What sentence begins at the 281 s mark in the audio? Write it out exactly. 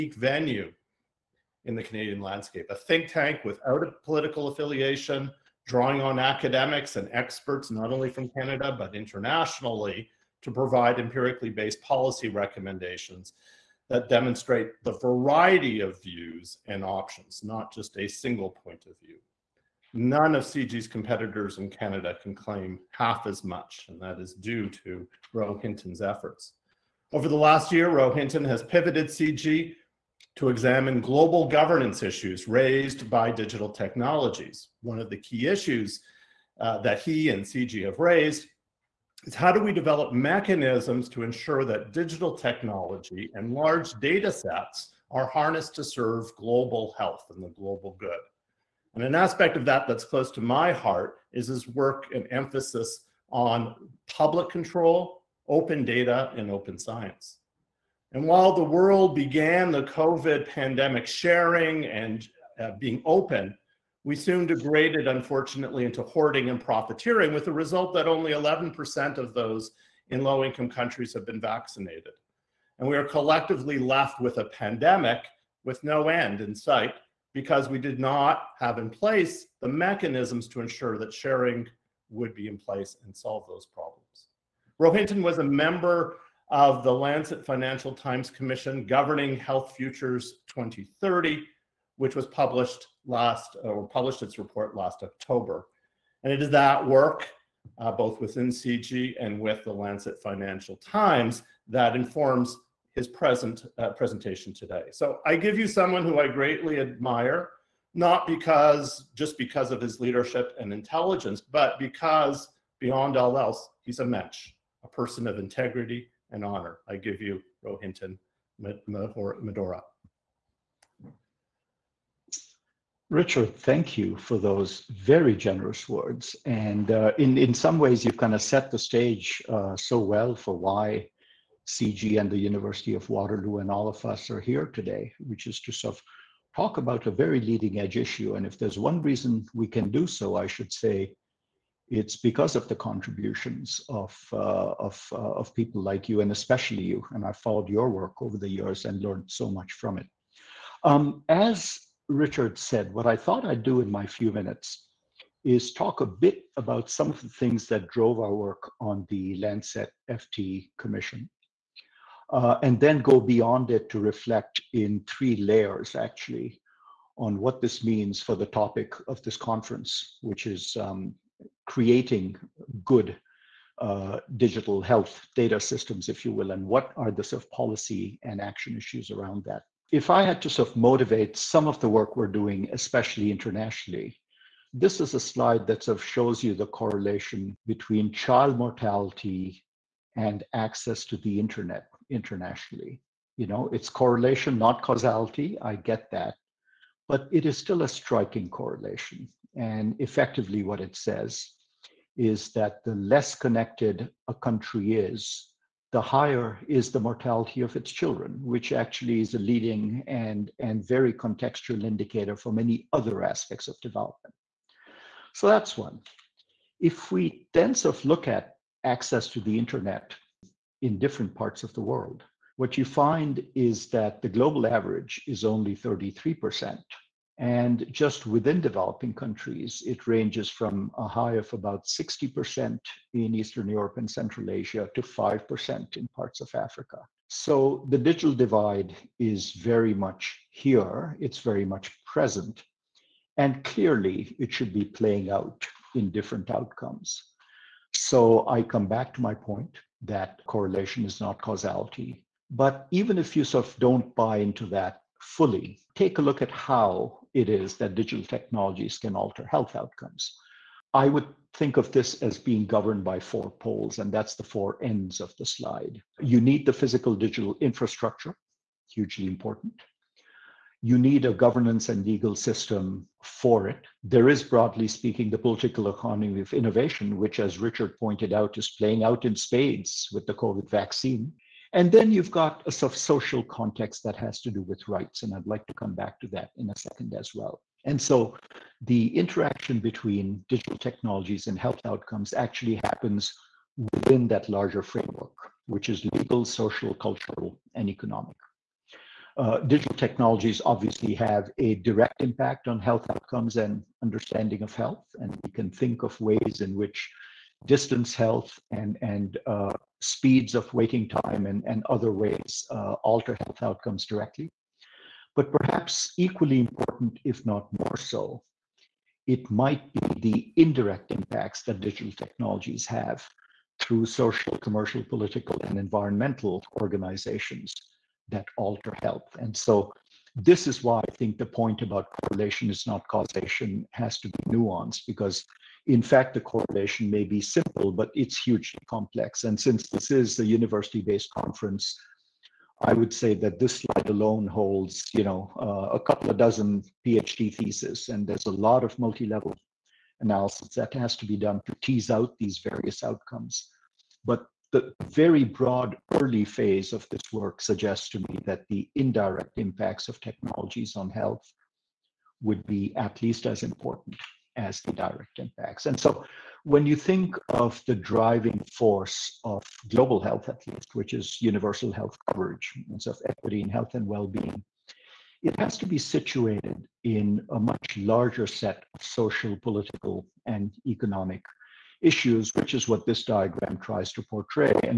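And then you've got a sort of social context that has to do with rights.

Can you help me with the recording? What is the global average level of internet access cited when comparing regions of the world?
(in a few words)
33%.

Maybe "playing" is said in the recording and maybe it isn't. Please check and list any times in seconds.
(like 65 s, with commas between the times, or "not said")
244 s, 278 s.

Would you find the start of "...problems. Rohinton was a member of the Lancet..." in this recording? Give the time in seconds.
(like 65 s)
83 s.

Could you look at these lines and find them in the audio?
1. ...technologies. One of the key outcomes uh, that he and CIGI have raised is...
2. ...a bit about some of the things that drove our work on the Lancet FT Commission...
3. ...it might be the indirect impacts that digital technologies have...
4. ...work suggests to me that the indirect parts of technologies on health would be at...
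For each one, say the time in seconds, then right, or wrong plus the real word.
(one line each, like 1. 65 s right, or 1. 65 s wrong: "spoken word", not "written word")
1. 33 s wrong: "issues", not "outcomes"
2. 156 s right
3. 319 s right
4. 357 s wrong: "impacts", not "parts".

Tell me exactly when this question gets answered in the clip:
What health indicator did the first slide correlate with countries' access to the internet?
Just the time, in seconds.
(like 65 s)
188 s.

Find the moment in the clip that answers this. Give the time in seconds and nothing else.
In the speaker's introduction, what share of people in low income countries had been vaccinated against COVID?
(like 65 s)
68 s.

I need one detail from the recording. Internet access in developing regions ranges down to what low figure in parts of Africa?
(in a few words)
5%.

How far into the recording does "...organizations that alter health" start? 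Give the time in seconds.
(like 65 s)
326 s.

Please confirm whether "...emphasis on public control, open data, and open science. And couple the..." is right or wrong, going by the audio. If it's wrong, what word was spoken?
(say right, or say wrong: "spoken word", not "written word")
wrong: "while", not "couple".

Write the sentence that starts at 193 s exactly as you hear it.
You know, it's correlation, not causality.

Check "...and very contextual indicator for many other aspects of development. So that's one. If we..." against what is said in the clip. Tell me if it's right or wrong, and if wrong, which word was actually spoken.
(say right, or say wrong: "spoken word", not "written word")
right.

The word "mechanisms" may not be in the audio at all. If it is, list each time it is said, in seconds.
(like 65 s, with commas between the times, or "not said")
40 s, 79 s.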